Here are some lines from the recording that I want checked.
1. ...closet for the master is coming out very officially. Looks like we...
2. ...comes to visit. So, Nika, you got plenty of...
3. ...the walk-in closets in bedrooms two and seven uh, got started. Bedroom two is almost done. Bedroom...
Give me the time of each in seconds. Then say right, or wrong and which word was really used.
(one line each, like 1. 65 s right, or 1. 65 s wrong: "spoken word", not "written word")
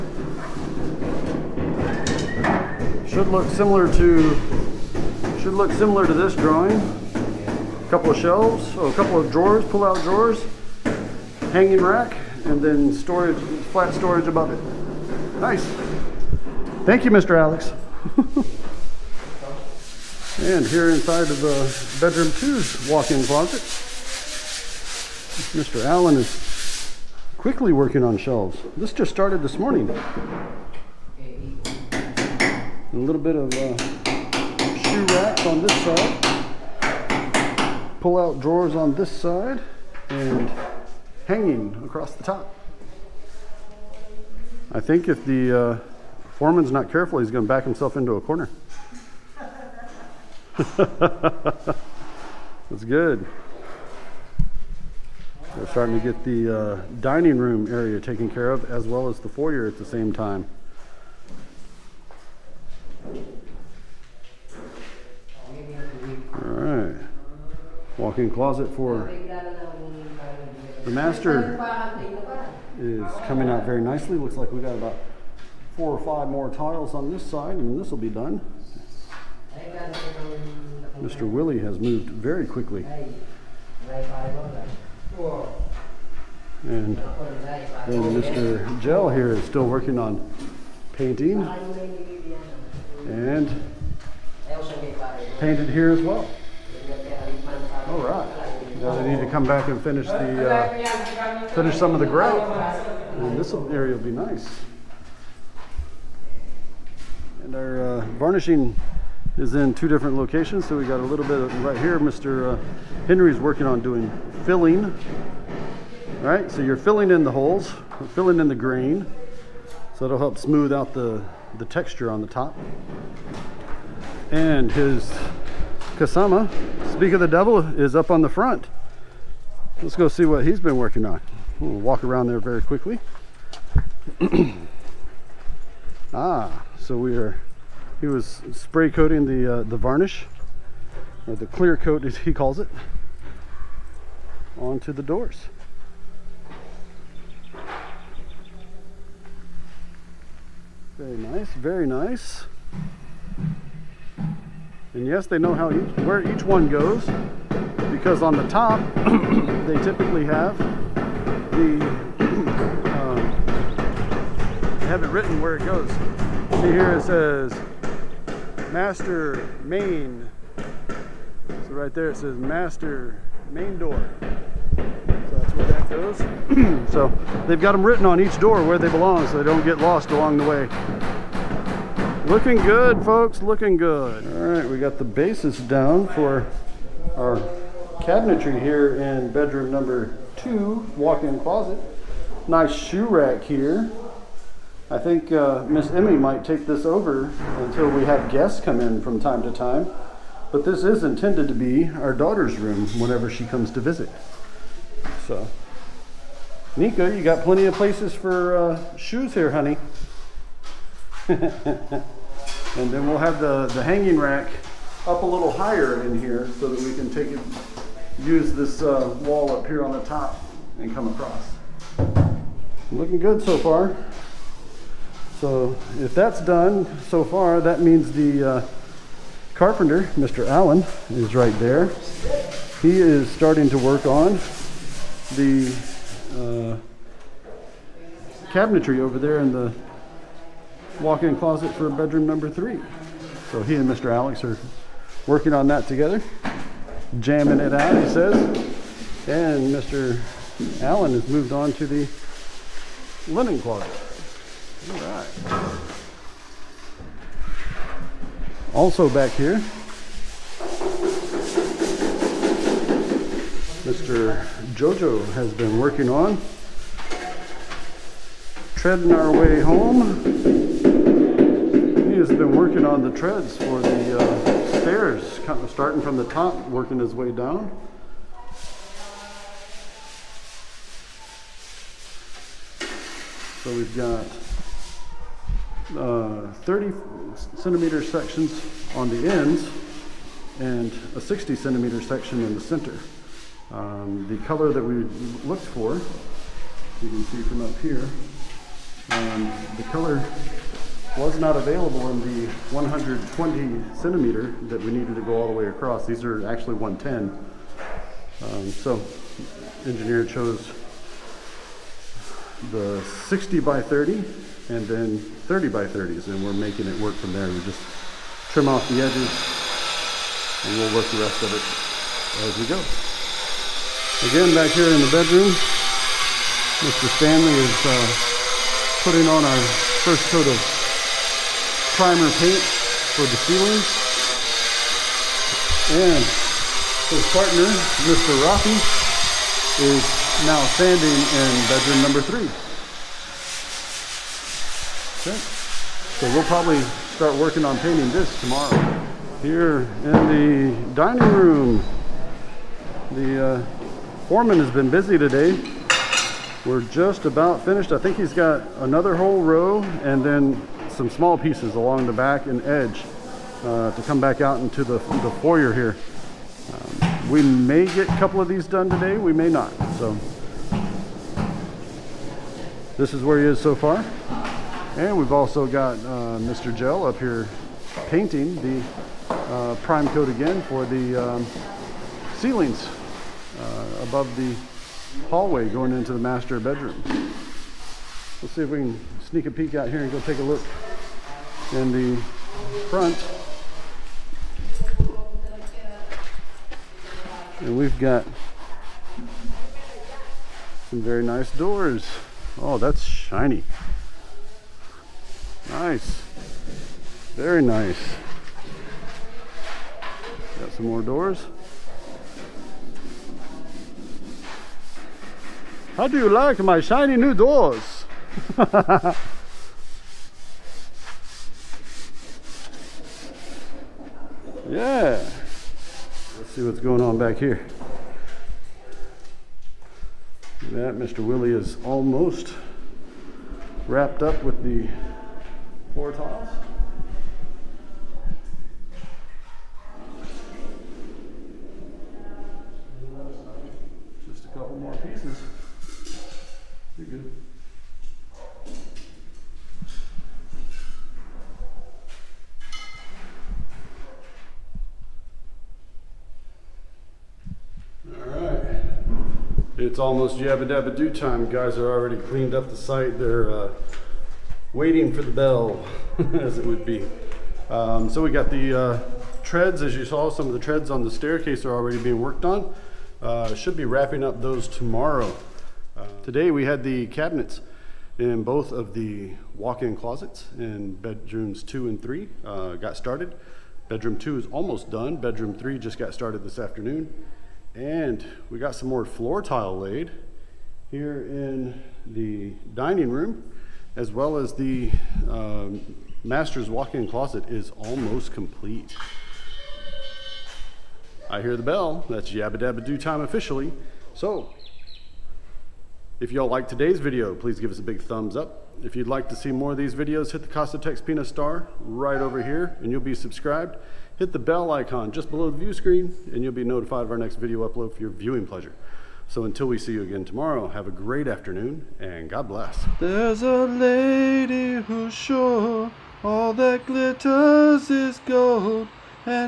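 1. 68 s wrong: "nicely", not "officially"
2. 203 s right
3. 478 s wrong: "three", not "seven".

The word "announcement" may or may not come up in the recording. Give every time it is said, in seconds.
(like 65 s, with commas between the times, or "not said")
not said.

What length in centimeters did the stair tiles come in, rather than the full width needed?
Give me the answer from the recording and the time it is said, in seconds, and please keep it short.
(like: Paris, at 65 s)
110, at 306 s.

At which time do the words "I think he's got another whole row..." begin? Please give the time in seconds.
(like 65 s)
357 s.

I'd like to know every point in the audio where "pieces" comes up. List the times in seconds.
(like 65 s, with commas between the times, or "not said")
361 s, 444 s.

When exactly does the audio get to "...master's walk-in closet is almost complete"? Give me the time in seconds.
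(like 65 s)
496 s.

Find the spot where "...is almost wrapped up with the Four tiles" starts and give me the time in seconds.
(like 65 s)
431 s.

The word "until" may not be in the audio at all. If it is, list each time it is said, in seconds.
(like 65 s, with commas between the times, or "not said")
197 s, 519 s.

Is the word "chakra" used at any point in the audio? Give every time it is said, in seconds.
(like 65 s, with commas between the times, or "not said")
not said.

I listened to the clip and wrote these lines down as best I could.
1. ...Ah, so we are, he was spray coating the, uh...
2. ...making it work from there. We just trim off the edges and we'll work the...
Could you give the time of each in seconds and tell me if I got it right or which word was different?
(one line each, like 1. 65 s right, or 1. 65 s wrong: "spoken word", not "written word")
1. 136 s right
2. 316 s right.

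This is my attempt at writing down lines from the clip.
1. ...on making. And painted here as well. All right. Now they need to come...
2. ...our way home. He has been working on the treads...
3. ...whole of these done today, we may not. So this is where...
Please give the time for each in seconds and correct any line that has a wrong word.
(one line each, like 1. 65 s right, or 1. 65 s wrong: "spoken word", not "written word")
1. 89 s wrong: "painting", not "making"
2. 269 s right
3. 368 s wrong: "couple", not "whole".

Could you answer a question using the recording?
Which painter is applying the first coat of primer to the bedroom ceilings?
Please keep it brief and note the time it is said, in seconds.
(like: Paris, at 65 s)
Mr. Stanley, at 326 s.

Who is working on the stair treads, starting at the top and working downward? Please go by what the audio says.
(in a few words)
Mr. Jojo.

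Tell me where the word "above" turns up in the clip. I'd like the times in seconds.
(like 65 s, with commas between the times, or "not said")
14 s, 384 s.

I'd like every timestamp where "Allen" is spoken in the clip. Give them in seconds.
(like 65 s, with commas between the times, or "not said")
25 s, 230 s, 250 s.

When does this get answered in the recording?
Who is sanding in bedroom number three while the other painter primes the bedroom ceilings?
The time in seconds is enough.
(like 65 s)
338 s.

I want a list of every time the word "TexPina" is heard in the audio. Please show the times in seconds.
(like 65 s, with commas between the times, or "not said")
510 s.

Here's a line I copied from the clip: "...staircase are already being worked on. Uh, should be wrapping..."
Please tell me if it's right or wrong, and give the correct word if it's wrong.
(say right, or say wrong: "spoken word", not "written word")
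right.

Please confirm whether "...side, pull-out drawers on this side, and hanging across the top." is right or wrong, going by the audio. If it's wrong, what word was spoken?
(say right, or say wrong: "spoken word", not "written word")
right.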